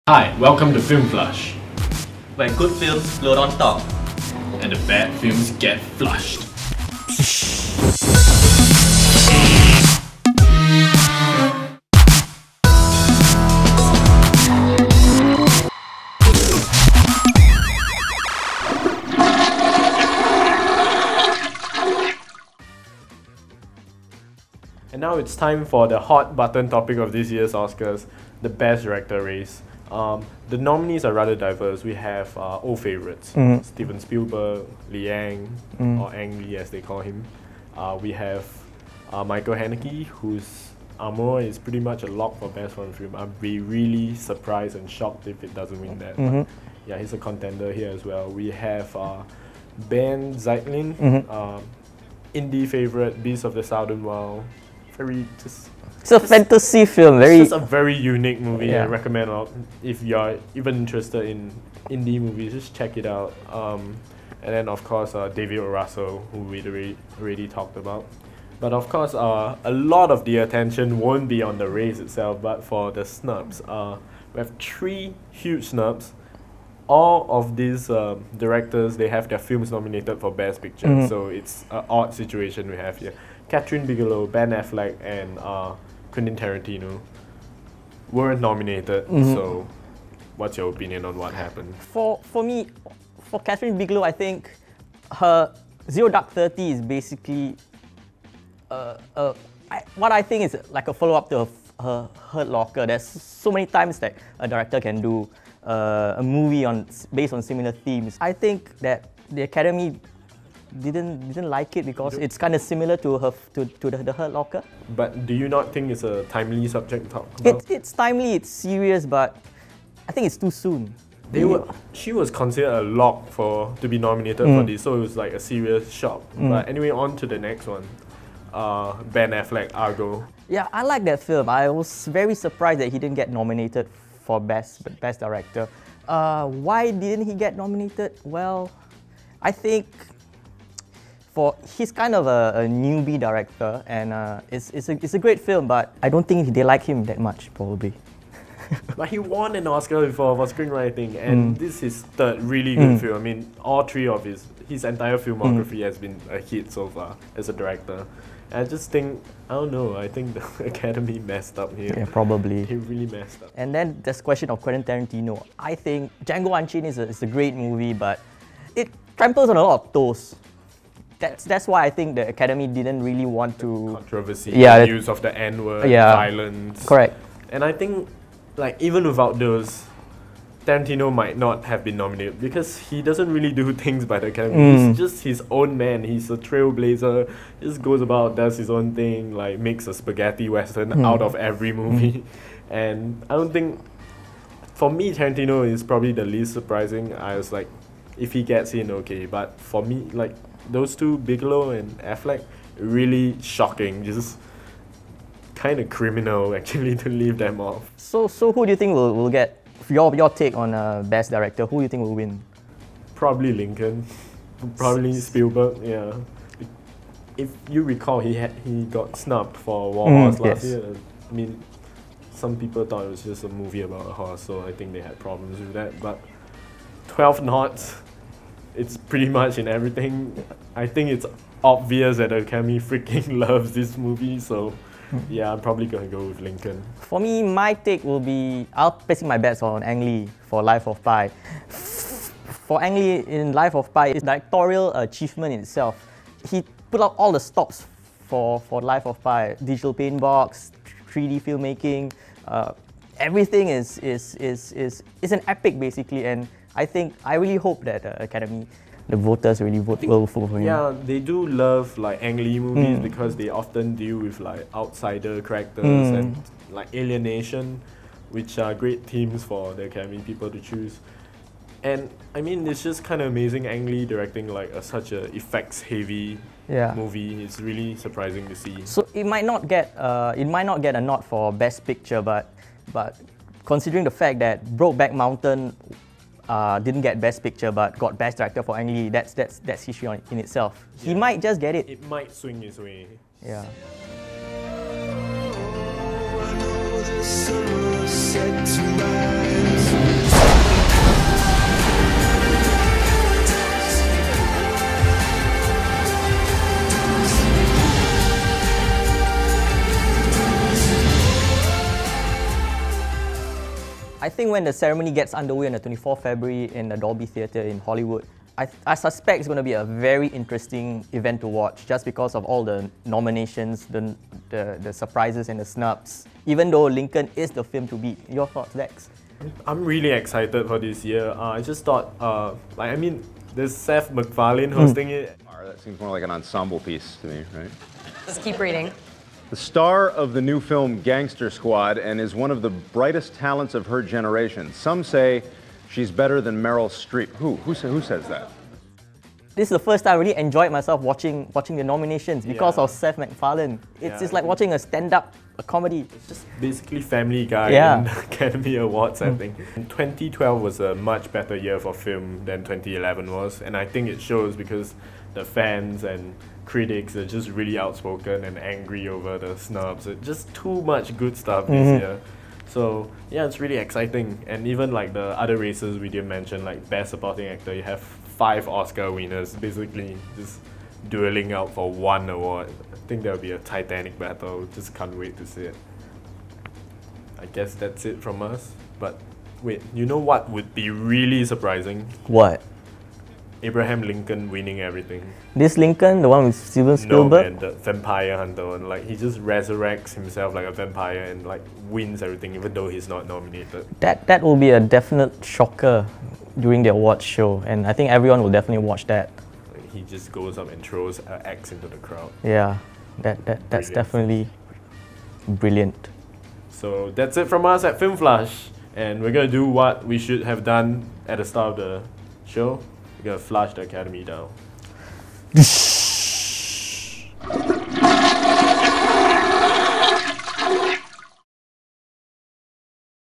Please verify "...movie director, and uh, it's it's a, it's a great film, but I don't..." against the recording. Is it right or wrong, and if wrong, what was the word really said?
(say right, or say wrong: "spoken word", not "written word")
wrong: "newbie", not "movie".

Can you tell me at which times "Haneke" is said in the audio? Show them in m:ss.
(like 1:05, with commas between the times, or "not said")
0:39.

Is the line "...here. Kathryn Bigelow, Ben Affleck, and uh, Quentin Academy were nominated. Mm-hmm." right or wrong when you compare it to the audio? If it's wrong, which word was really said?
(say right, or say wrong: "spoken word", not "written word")
wrong: "Tarantino", not "Academy".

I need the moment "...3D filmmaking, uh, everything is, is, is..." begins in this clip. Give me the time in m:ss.
4:11.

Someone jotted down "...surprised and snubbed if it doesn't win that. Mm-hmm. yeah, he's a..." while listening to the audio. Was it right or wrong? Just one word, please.
wrong.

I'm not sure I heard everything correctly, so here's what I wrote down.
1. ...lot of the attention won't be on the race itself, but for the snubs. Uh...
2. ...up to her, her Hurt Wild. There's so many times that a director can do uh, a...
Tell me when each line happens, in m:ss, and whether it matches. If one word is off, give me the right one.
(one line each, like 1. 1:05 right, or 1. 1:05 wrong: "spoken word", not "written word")
1. 1:09 right
2. 1:41 wrong: "Locker", not "Wild".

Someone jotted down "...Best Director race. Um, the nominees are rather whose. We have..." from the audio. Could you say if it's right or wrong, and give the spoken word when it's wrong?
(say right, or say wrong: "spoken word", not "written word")
wrong: "diverse", not "whose".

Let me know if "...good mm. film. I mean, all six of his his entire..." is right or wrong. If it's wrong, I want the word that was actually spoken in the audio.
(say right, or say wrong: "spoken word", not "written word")
wrong: "three", not "six".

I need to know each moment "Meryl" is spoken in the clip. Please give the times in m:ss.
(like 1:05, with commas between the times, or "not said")
5:46.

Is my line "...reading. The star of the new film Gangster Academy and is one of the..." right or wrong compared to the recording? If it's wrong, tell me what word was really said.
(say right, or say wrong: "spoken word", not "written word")
wrong: "Squad", not "Academy".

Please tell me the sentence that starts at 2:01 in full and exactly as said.
They were, she was considered a lock for to be nominated mm.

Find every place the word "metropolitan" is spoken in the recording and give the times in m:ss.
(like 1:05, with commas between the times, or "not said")
not said.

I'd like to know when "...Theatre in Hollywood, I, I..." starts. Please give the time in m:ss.
5:17.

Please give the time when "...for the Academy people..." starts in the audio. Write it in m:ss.
4:29.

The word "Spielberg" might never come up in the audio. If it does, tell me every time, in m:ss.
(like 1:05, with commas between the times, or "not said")
0:33, 3:35, 6:36.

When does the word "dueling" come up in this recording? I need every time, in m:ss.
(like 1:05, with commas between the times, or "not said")
6:21.